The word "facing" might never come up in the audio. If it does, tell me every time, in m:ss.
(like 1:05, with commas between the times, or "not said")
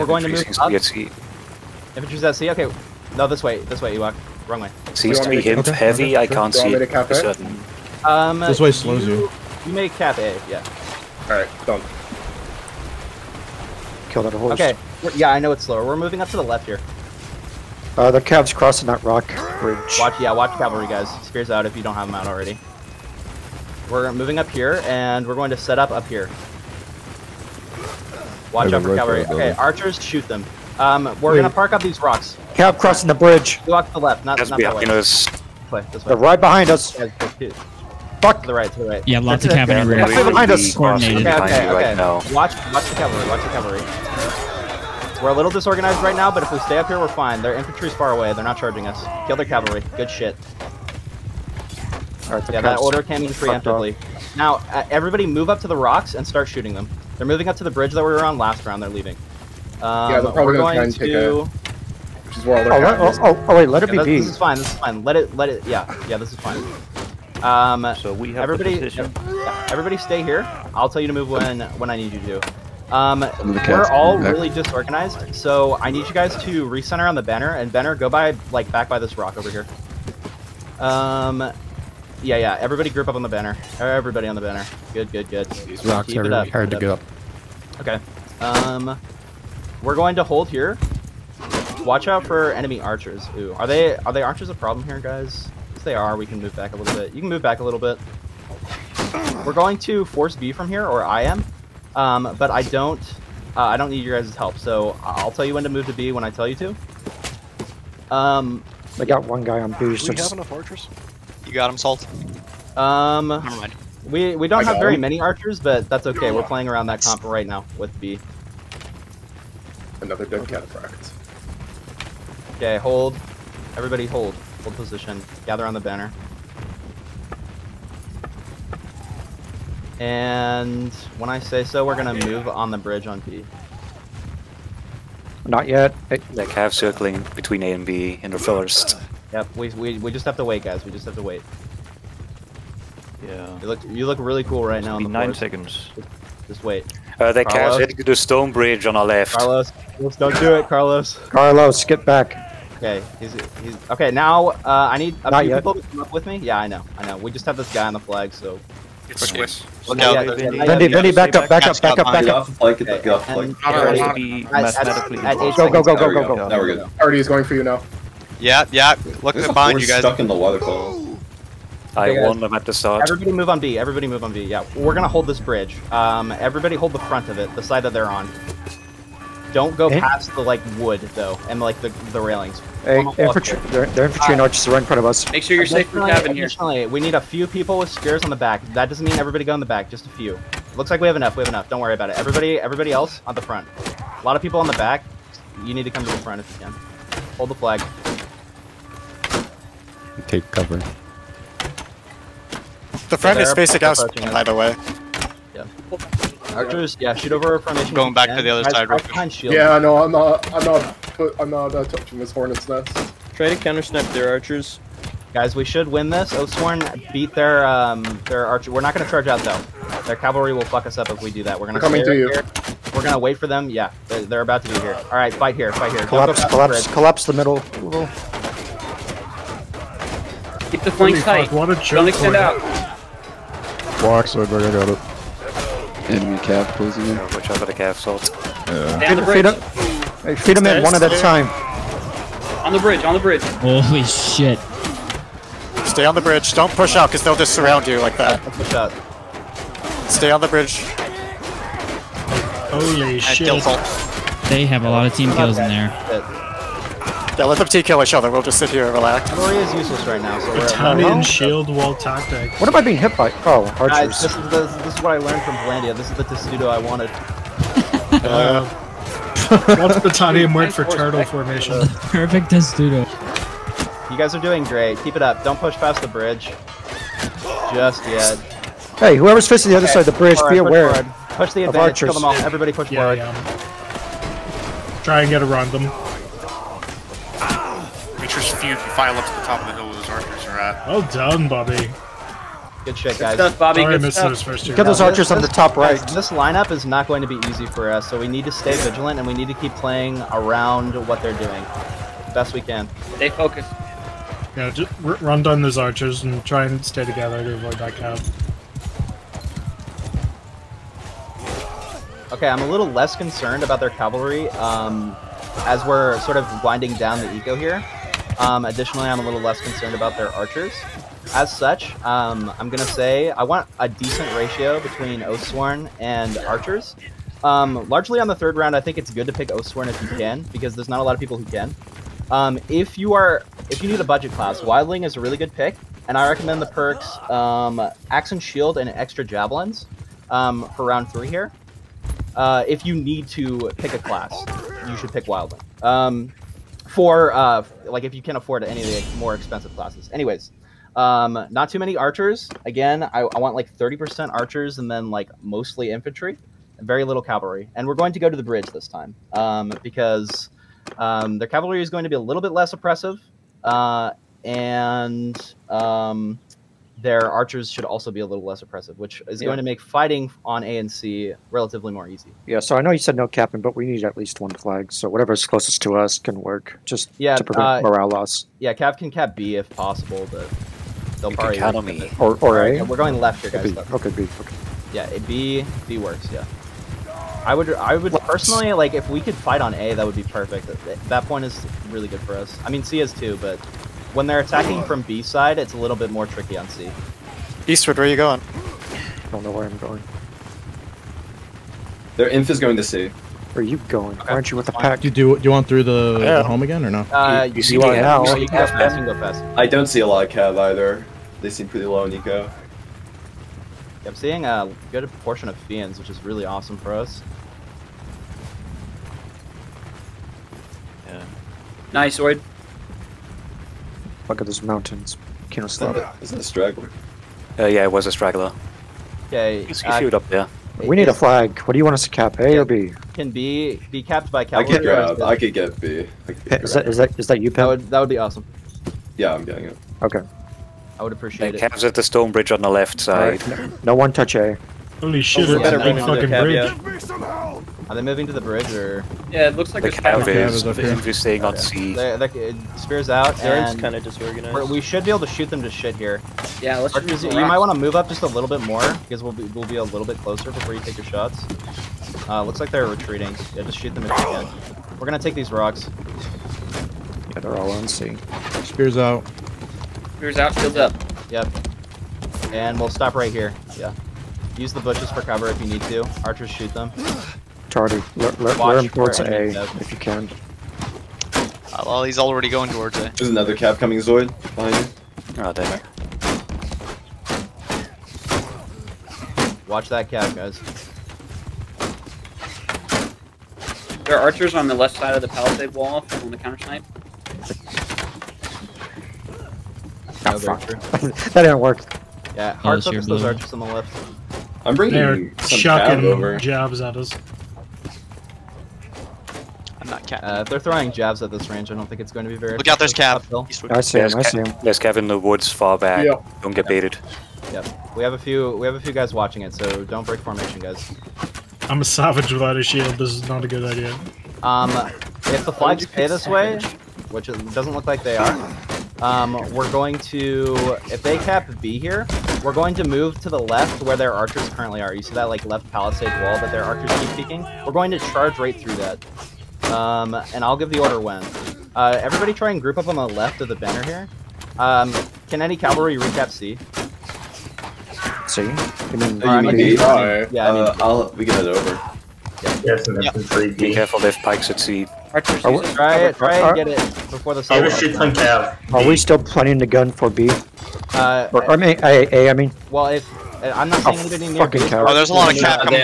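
3:23, 4:39.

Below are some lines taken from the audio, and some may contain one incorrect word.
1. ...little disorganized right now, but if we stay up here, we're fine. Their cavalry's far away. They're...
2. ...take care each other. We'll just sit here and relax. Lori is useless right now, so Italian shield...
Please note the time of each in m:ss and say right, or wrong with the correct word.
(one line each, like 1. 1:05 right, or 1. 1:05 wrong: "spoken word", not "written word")
1. 0:45 wrong: "infantry", not "cavalry"
2. 4:17 right.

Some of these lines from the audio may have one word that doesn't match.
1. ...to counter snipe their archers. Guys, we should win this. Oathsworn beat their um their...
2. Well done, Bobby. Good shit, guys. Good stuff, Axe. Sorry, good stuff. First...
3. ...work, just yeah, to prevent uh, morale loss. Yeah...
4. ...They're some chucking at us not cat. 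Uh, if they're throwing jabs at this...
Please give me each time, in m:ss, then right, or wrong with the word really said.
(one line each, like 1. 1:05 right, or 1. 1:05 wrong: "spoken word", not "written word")
1. 3:33 right
2. 4:50 wrong: "Bobby", not "Axe"
3. 6:16 right
4. 8:24 right.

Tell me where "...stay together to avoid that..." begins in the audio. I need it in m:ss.
5:06.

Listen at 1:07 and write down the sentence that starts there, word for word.
Um, so we have everybody, everybody stay here.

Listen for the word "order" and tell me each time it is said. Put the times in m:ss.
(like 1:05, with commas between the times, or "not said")
0:52, 9:00.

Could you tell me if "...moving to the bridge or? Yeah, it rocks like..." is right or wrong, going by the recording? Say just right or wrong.
wrong.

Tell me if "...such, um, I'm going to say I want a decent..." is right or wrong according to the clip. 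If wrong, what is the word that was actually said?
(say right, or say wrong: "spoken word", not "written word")
right.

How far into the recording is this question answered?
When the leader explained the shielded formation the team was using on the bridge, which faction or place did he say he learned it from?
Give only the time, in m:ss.
4:25.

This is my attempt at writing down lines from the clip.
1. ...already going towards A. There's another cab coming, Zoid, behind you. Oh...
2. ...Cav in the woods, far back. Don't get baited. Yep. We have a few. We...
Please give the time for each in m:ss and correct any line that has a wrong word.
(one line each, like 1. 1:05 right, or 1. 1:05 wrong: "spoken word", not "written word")
1. 8:02 right
2. 8:34 right.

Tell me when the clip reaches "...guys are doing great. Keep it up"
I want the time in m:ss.
4:34.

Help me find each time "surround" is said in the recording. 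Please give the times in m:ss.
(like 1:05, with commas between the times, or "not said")
4:07.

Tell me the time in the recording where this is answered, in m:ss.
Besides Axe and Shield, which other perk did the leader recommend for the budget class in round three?
5:38.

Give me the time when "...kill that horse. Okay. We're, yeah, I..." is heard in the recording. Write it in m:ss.
0:14.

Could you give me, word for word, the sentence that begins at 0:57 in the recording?
They're moving up to the bridge that we were on last round.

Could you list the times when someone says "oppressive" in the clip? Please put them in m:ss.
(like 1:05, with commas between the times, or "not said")
6:02, 6:08.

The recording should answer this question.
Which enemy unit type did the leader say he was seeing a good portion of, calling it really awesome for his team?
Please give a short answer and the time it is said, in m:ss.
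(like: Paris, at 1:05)
Fians, at 6:55.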